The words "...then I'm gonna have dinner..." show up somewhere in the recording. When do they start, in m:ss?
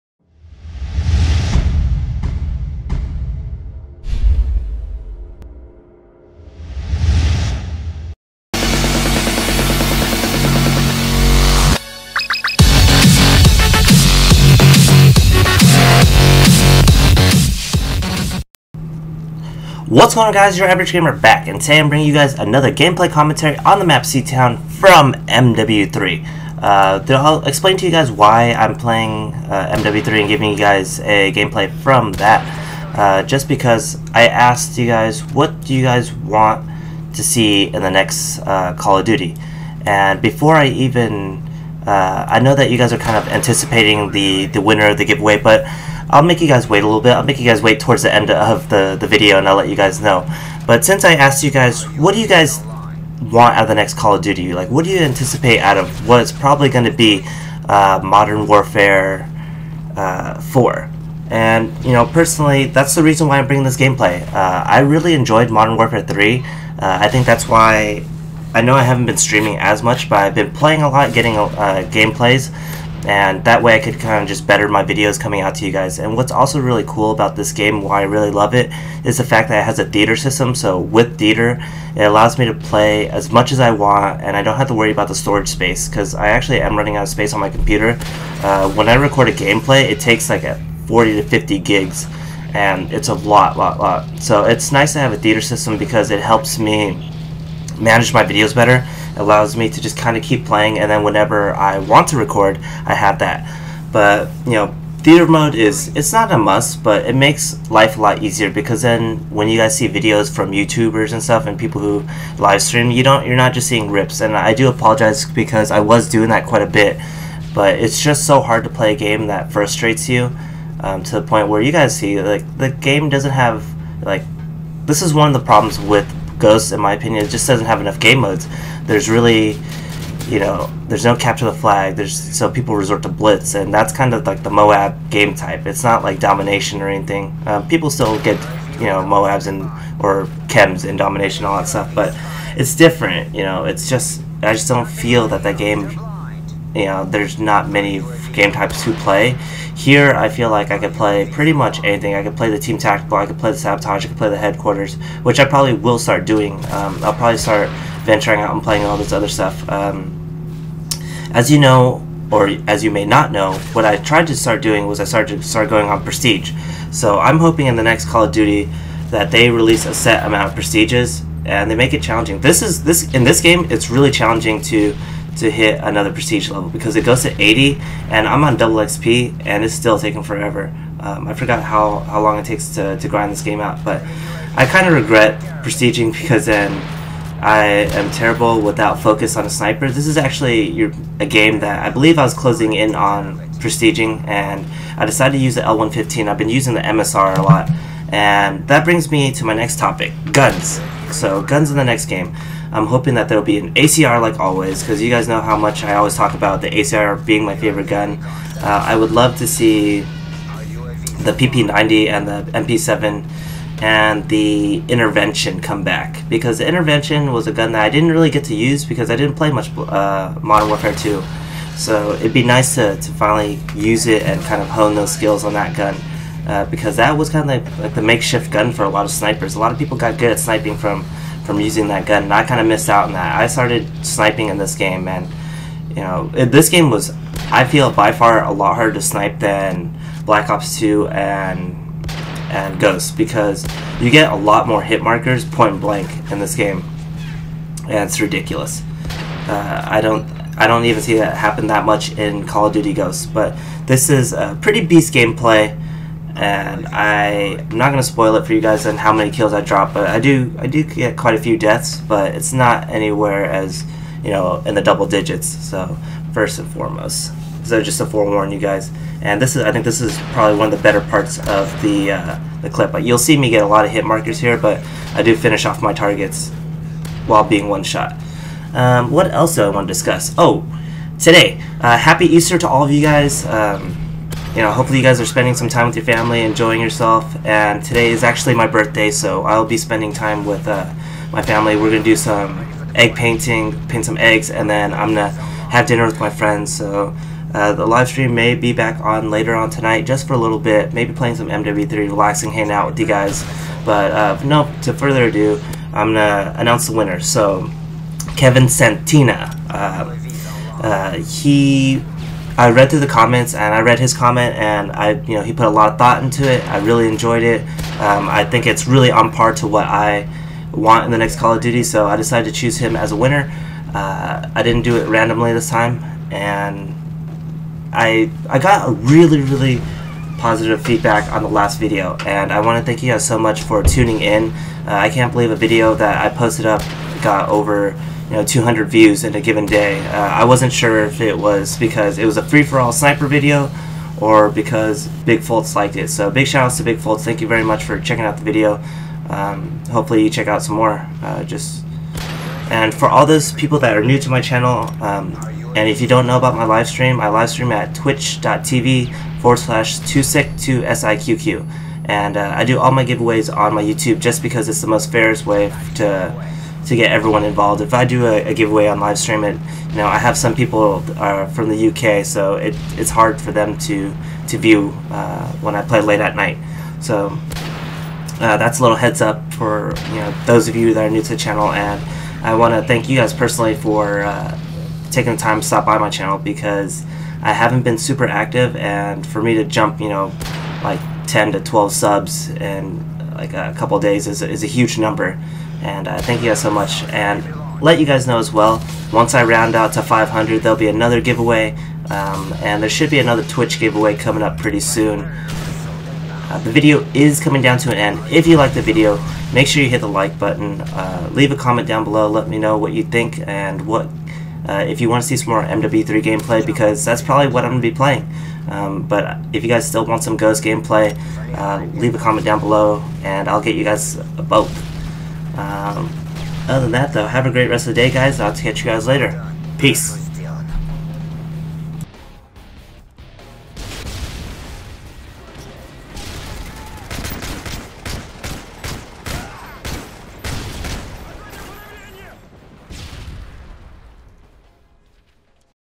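4:54.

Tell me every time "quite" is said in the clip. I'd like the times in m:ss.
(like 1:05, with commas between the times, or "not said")
1:56, 4:21.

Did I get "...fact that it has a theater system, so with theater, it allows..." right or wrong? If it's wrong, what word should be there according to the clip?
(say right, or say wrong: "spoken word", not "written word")
right.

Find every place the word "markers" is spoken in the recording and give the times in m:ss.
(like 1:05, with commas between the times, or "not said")
4:05, 4:34.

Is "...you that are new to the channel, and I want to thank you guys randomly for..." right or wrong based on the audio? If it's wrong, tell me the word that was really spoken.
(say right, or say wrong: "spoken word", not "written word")
wrong: "personally", not "randomly".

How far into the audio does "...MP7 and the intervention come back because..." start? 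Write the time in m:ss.
3:32.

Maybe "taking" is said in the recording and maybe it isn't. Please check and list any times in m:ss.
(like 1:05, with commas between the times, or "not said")
2:59, 6:25.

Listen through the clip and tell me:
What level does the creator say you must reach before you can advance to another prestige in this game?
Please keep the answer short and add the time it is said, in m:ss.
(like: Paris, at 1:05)
80, at 2:57.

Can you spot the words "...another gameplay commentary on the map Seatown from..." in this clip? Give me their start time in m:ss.
0:22.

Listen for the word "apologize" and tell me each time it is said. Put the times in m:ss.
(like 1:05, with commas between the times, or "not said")
1:54.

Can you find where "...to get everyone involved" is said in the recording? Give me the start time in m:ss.
6:06.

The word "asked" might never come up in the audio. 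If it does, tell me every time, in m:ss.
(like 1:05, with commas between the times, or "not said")
0:34, 0:51.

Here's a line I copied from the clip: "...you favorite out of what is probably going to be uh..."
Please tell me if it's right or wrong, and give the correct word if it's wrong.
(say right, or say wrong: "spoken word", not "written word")
wrong: "anticipate", not "favorite".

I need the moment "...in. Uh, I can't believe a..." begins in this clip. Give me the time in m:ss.
5:34.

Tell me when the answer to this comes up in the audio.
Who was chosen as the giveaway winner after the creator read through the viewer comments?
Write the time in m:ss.
5:08.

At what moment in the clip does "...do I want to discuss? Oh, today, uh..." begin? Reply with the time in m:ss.
4:39.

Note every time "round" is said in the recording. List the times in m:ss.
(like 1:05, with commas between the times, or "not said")
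6:39.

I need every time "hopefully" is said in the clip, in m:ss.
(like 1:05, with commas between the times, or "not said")
4:44, 5:49.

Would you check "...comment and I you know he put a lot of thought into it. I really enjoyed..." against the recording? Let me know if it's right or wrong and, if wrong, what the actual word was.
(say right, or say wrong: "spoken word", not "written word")
right.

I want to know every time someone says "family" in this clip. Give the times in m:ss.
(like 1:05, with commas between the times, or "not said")
4:46, 4:51.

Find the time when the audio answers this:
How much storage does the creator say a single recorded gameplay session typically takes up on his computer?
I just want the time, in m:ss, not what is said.
1:30.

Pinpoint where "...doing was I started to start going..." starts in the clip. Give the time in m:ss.
2:44.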